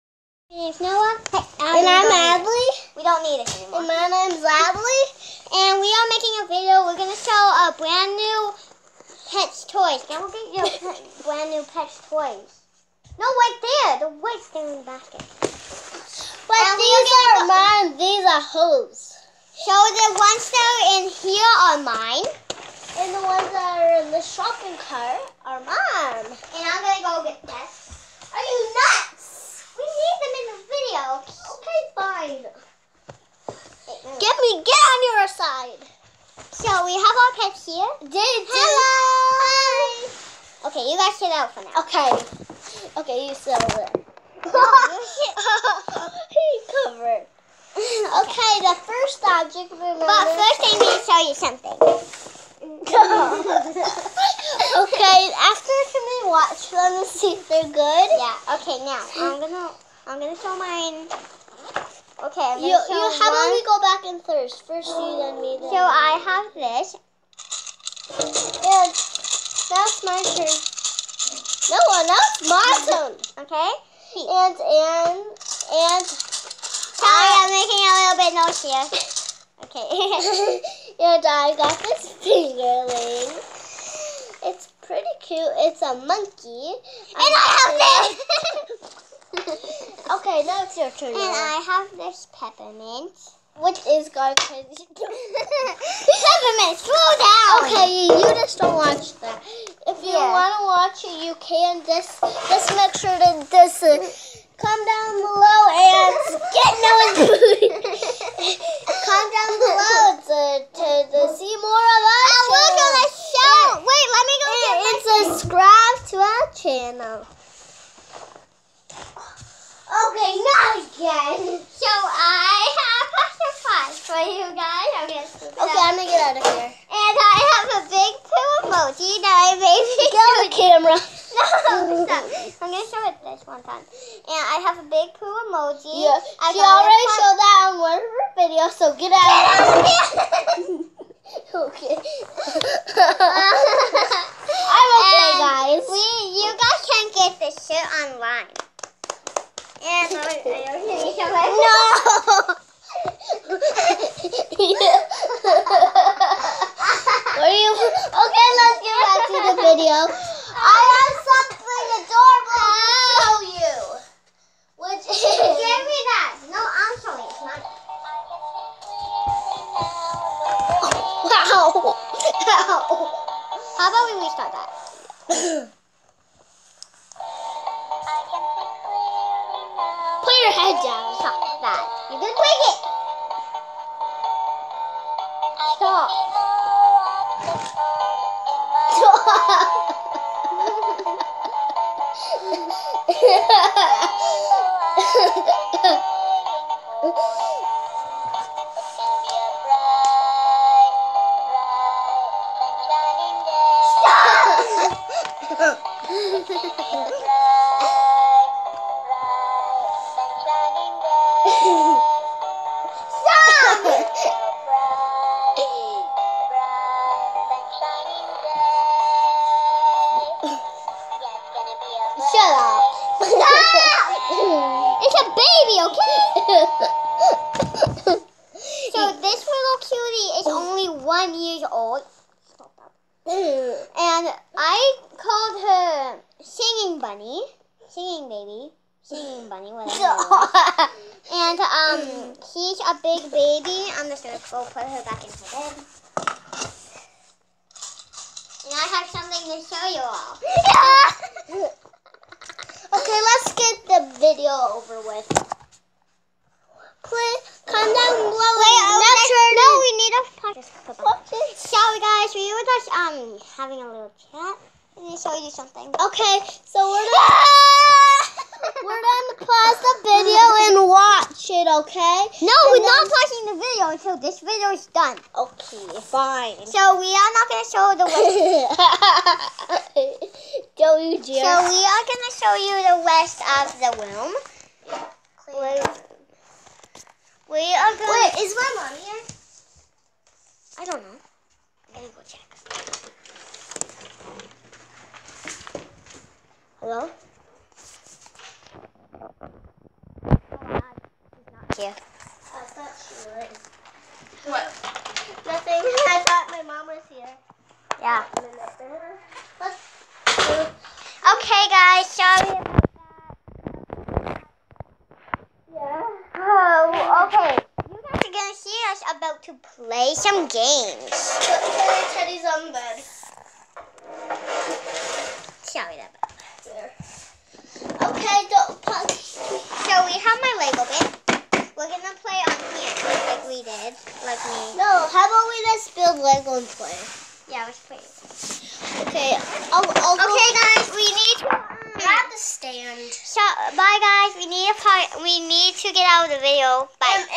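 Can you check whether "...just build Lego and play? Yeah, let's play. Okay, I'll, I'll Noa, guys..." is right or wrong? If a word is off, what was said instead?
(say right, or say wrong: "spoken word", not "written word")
wrong: "Okay", not "Noa".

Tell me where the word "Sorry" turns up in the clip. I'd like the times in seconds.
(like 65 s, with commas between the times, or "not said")
76 s, 261 s, 312 s.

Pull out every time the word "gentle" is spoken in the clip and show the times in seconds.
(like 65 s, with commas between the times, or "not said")
not said.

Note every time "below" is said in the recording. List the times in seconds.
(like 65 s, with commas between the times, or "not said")
105 s, 258 s.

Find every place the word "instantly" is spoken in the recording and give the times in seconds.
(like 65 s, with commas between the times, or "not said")
not said.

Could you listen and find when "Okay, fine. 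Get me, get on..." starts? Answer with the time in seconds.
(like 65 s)
31 s.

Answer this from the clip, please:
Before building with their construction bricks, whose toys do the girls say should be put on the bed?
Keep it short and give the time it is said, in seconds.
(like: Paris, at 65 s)
Teddy's, at 322 s.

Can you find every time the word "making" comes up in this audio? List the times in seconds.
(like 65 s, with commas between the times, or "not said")
6 s, 78 s.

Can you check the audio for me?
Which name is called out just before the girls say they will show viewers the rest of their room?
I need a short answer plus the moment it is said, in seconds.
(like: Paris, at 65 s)
Joey, at 280 s.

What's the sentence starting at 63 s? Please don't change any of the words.
about we go back in first?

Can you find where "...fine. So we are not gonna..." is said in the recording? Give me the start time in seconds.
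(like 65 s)
276 s.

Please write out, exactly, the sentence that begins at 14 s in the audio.
The white thing in the basket.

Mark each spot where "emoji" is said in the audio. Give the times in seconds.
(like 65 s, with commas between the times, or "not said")
128 s, 135 s.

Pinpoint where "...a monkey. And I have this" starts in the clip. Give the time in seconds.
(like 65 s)
85 s.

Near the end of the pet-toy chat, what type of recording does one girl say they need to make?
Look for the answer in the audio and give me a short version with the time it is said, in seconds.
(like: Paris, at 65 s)
a podcast, at 260 s.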